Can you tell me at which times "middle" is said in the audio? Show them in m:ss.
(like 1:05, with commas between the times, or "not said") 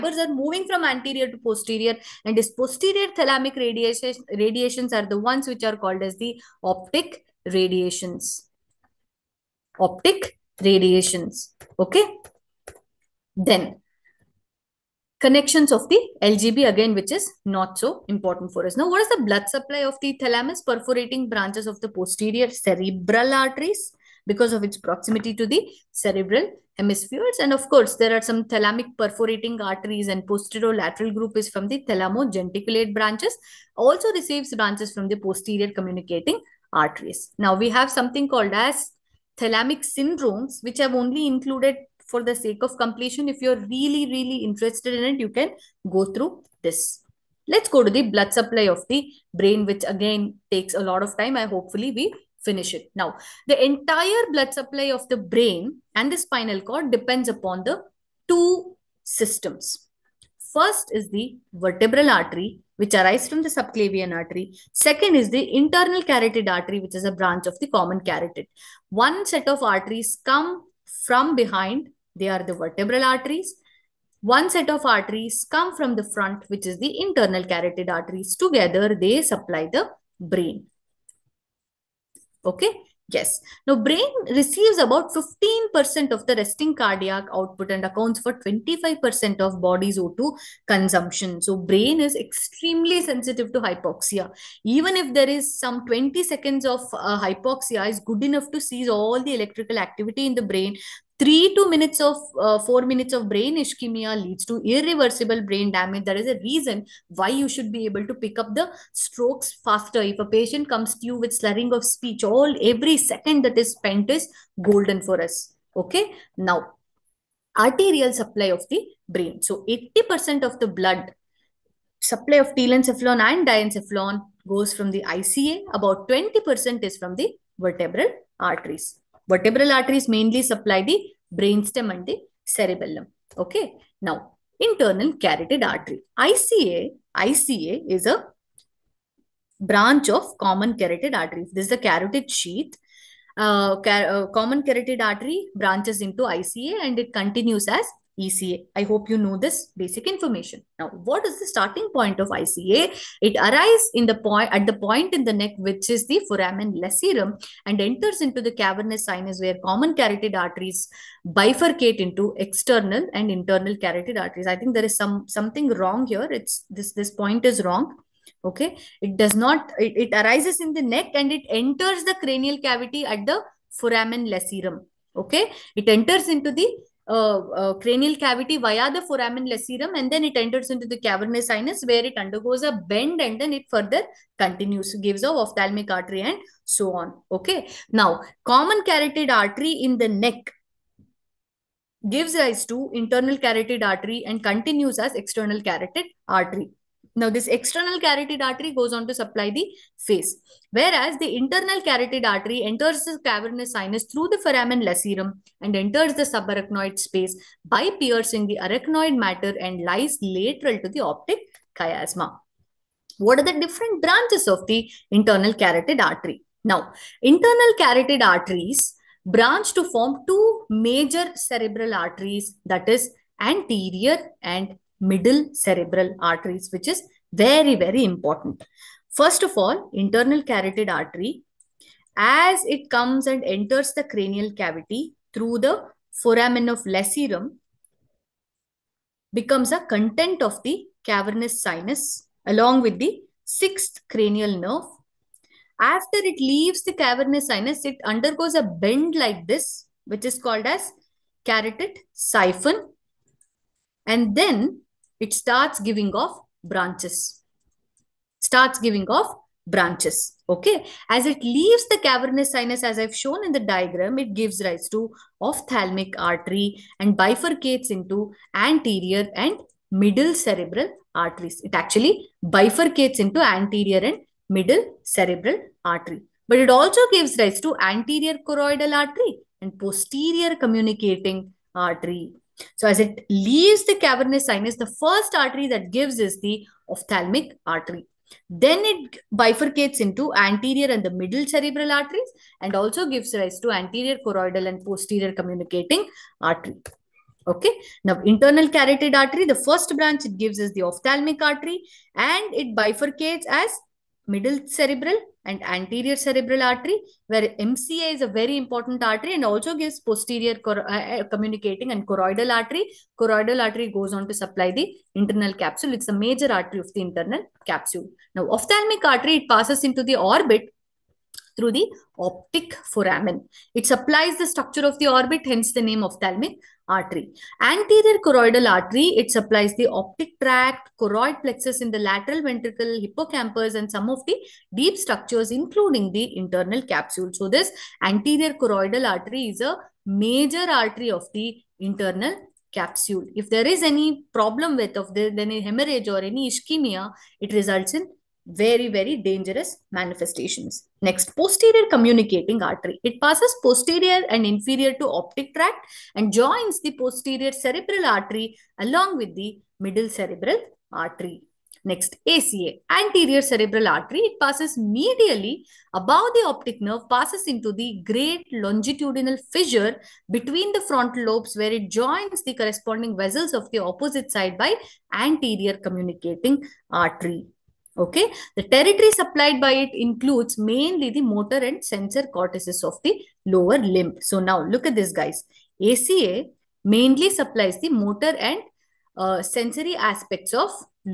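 3:44, 4:29, 4:34, 4:51, 5:04, 5:59.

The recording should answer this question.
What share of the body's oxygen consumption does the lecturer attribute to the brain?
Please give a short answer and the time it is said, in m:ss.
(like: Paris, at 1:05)
25%, at 1:28.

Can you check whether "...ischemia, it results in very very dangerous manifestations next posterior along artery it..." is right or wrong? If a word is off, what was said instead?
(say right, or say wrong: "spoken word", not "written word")
wrong: "communicating", not "along".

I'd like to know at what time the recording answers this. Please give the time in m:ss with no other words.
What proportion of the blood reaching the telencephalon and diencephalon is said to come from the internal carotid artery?
1:59.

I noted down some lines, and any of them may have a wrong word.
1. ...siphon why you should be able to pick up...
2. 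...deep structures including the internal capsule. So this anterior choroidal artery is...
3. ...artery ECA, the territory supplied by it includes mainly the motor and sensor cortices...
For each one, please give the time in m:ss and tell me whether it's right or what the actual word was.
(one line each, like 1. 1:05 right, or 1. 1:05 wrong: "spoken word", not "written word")
1. 1:46 wrong: "reason", not "siphon"
2. 5:34 right
3. 6:16 wrong: "Okay", not "ECA".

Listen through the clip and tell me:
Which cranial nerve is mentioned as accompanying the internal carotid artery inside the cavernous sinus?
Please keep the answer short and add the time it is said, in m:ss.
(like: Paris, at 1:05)
Sixth cranial nerve, at 4:03.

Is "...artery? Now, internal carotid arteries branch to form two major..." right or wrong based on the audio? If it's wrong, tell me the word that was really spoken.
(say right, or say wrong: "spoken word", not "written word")
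right.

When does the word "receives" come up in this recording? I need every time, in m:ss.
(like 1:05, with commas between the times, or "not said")
0:34, 1:24.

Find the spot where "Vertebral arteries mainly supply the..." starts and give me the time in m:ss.
2:09.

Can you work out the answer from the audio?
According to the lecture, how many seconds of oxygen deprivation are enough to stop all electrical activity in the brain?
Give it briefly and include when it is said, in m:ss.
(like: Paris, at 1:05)
20 seconds, at 1:35.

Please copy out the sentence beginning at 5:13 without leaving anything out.
Choroidal artery goes on to supply the internal capsule.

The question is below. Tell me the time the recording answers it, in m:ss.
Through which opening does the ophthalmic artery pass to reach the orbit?
5:22.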